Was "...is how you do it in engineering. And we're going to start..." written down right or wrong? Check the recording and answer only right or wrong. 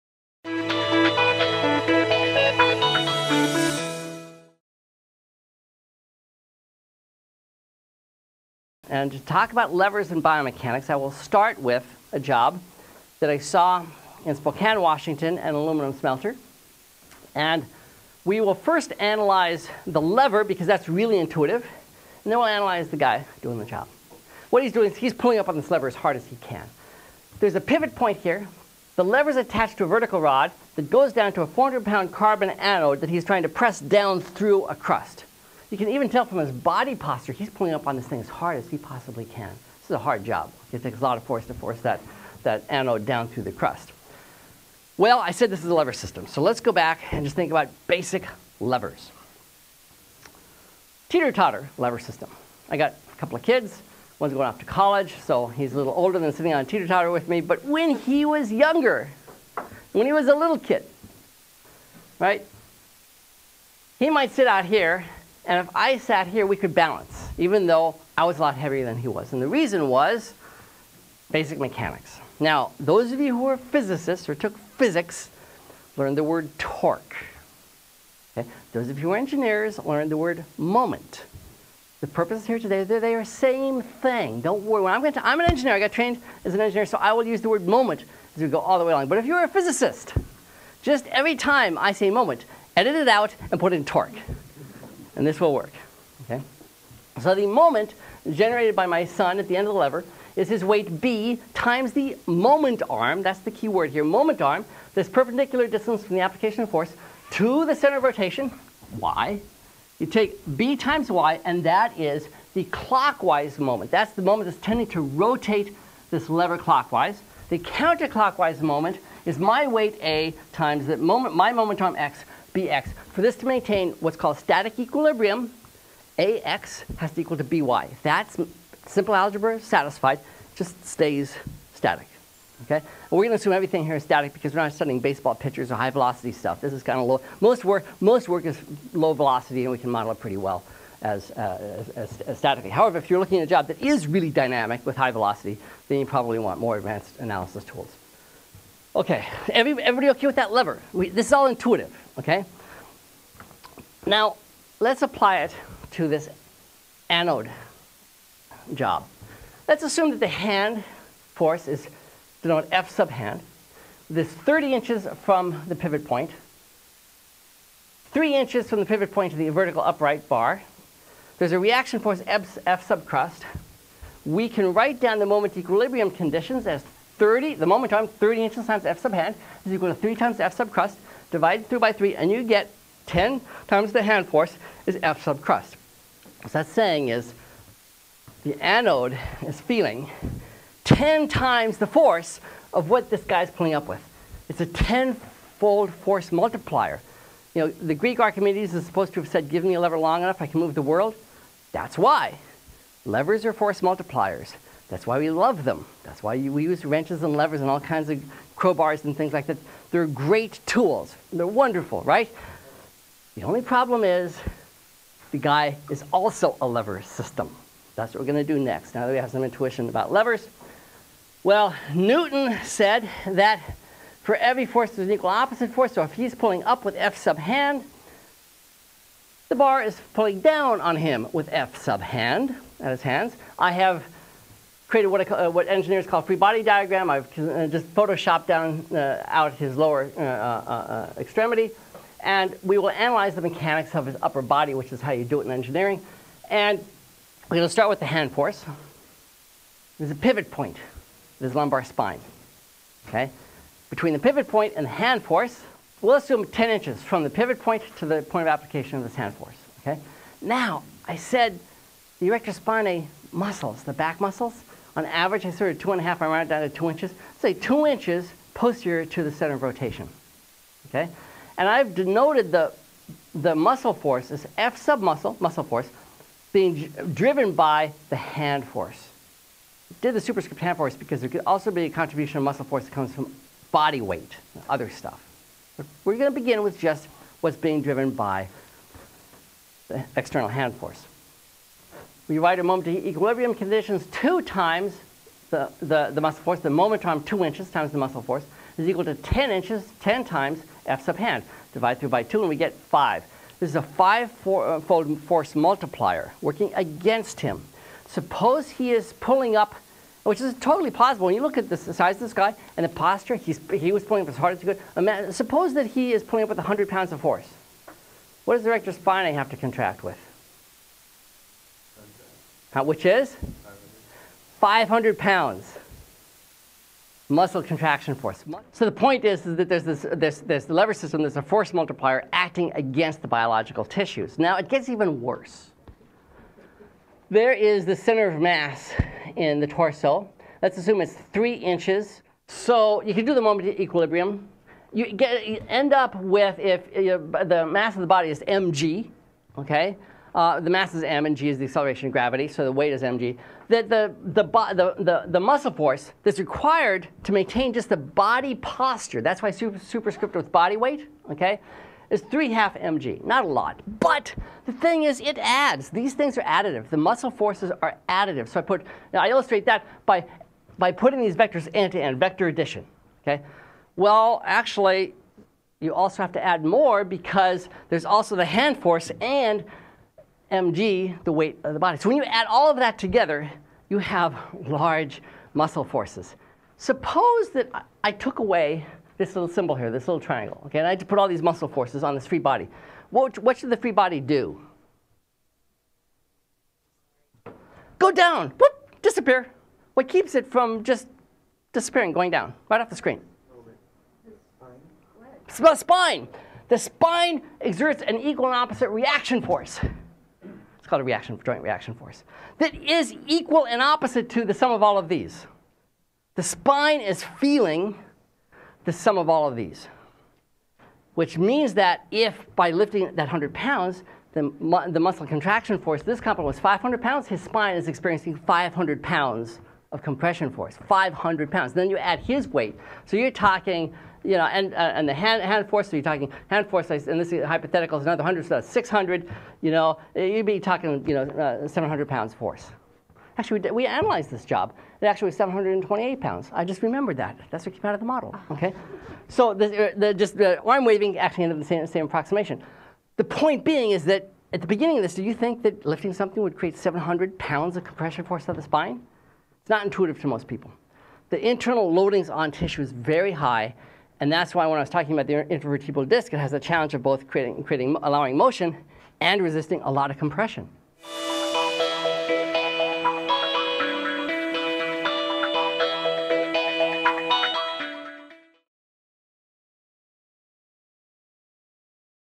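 right.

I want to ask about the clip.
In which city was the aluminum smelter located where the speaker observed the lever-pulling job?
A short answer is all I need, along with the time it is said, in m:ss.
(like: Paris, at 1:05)
Spokane, Washington, at 0:14.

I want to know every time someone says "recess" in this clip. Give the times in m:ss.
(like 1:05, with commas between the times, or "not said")
not said.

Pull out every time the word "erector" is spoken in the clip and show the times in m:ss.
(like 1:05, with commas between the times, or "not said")
4:22, 5:18.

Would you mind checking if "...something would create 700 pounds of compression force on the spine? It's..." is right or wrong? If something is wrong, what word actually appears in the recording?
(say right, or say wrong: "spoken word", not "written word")
right.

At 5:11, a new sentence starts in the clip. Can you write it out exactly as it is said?
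When you look at the size of this guy and the posture, he's, he was pulling up as hard as he could.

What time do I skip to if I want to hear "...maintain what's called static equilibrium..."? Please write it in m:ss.
2:03.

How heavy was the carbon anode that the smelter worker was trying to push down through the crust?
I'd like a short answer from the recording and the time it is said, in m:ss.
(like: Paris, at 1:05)
400 pounds, at 0:31.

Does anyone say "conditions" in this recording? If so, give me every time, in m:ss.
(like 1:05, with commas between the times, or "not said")
2:56, 4:53.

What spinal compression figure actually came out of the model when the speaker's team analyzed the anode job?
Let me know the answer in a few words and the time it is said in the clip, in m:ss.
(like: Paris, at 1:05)
728 pounds, at 7:25.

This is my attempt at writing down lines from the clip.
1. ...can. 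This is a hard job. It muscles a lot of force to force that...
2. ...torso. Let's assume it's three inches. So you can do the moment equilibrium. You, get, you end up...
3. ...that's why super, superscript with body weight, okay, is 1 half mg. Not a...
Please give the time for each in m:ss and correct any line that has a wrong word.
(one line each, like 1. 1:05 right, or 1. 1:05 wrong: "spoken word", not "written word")
1. 0:39 wrong: "takes", not "muscles"
2. 5:39 right
3. 5:59 wrong: "3", not "1".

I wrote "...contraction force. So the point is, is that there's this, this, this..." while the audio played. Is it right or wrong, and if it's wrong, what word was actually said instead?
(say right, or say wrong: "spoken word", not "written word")
right.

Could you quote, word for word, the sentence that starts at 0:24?
What he's doing is he's pulling up on this lever as hard as he can.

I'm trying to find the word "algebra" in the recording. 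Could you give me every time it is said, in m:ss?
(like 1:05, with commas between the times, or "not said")
2:09.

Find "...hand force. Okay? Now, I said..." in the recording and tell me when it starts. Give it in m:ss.
4:19.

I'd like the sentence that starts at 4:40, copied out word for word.
Did the superscript hand force because there could also be a contribution of muscle force that comes from body weight, other stuff.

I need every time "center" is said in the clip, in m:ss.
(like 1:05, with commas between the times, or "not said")
1:47, 4:29, 5:37.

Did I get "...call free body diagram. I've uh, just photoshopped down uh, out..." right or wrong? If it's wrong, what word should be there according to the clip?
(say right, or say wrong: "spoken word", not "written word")
right.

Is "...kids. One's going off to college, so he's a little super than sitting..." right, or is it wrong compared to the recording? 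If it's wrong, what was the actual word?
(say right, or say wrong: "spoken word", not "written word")
wrong: "older", not "super".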